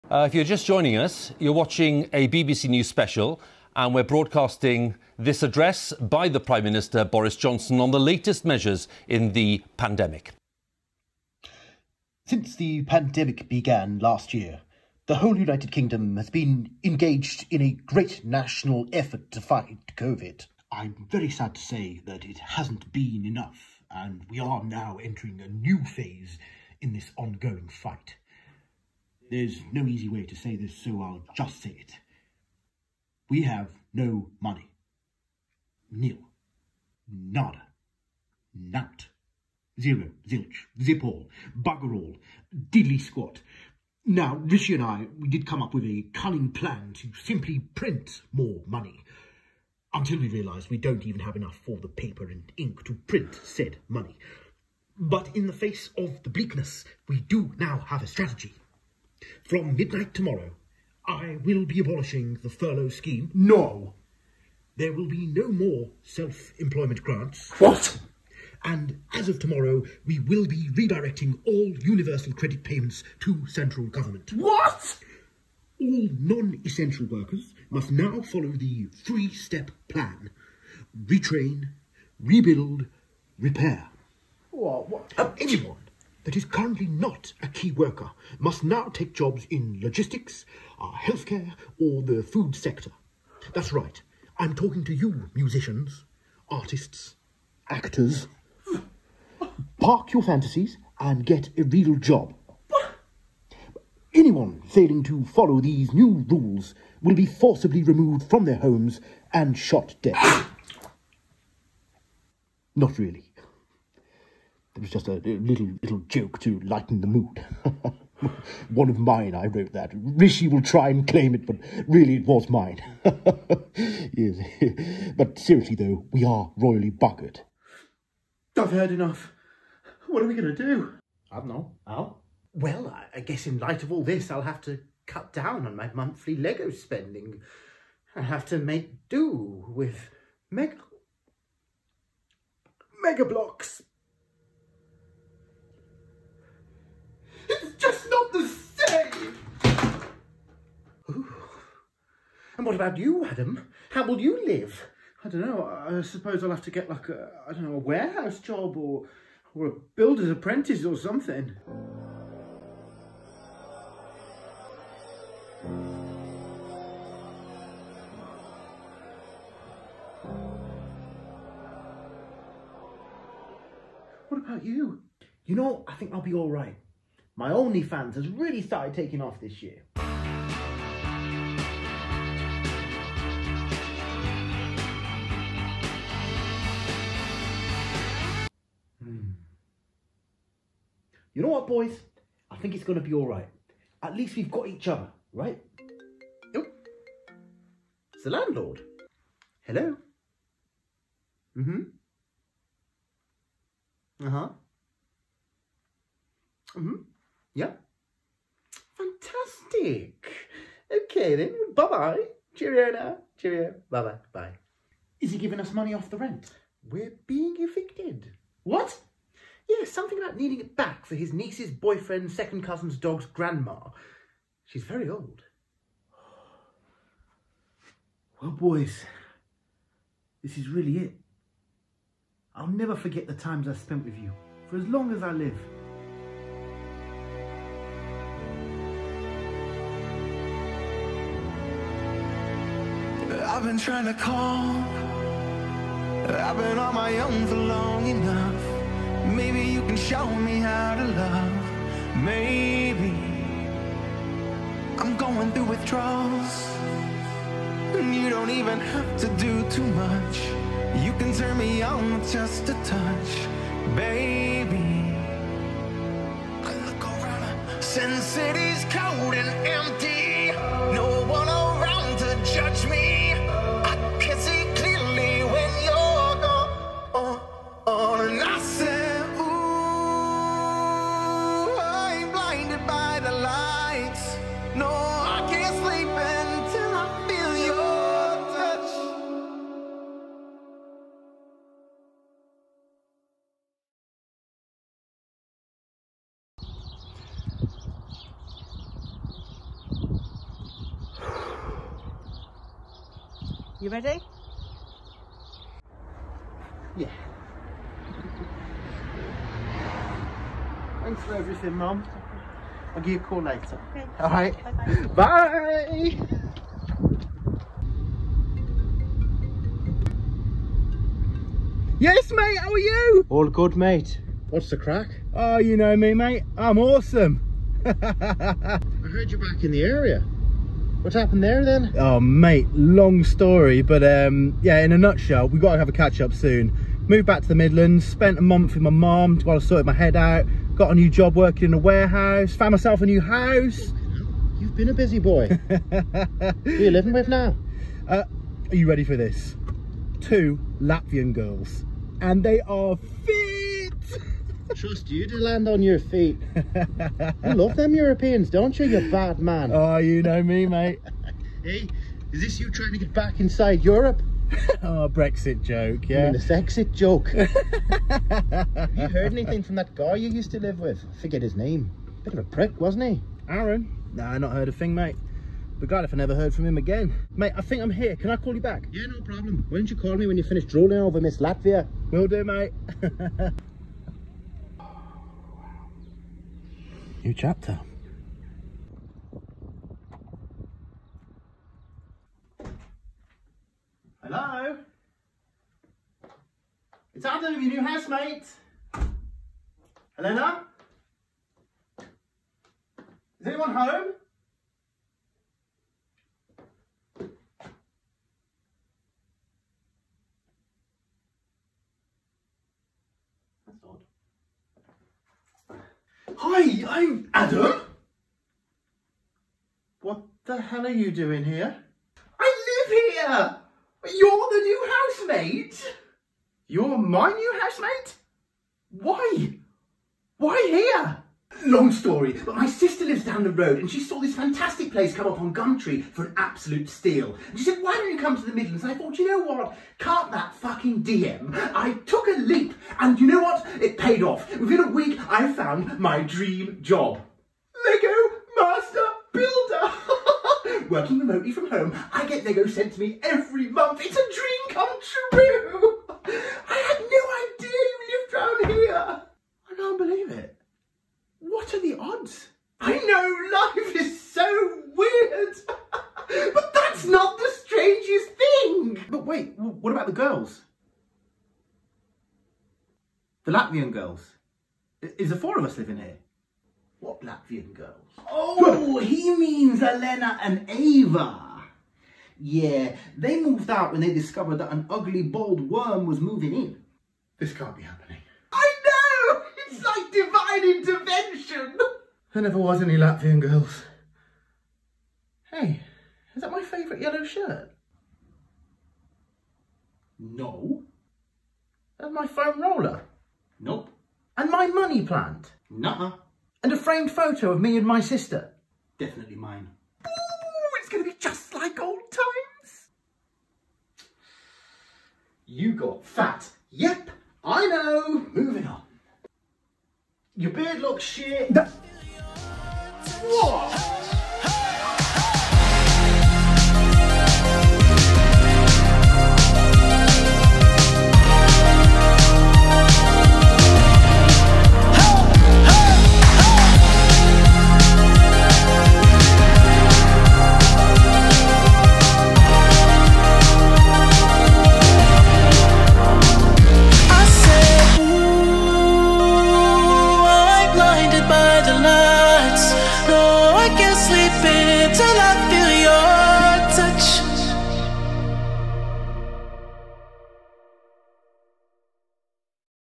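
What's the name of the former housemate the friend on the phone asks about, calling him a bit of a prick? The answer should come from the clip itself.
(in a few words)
Aaron.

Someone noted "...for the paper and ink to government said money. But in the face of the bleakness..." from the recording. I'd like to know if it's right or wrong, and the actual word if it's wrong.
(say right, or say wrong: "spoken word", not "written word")
wrong: "print", not "government".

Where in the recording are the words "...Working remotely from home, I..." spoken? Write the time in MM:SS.
07:30.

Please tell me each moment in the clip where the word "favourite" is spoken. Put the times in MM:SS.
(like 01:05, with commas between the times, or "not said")
08:16.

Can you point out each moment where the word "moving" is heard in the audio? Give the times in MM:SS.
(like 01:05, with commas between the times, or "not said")
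08:06, 08:38.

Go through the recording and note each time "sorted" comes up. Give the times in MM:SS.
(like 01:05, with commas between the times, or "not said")
05:39.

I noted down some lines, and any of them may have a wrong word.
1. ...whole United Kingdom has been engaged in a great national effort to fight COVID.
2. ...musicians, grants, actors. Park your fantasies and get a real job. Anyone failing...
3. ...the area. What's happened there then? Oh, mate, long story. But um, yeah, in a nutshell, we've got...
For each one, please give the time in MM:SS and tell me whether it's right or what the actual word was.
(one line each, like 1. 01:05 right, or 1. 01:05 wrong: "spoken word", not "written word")
1. 00:15 right
2. 01:35 wrong: "artists", not "grants"
3. 05:29 right.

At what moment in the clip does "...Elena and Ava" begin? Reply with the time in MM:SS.
07:59.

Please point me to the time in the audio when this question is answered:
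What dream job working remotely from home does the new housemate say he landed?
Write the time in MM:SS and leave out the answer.
07:27.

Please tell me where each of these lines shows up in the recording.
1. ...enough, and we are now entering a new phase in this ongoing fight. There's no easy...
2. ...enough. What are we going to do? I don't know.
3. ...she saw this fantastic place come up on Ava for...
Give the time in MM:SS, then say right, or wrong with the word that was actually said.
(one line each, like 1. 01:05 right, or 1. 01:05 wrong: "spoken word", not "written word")
1. 00:23 right
2. 02:08 right
3. 07:13 wrong: "Gumtree", not "Ava".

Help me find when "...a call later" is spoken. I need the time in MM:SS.
05:13.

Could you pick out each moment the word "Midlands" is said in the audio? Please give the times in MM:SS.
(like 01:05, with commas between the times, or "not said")
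05:37, 07:18.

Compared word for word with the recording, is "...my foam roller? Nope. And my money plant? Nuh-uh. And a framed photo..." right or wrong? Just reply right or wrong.
right.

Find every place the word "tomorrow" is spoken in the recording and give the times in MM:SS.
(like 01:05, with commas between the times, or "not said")
01:00, 01:09.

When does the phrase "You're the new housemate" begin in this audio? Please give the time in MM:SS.
07:04.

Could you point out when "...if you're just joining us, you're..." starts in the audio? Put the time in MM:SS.
00:00.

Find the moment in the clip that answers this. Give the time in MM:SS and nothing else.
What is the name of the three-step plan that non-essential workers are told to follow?
01:21.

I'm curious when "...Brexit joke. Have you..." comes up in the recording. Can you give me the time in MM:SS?
06:06.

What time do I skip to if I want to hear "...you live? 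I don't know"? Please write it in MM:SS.
02:34.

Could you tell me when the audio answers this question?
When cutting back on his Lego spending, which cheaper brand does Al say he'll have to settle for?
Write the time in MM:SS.
02:23.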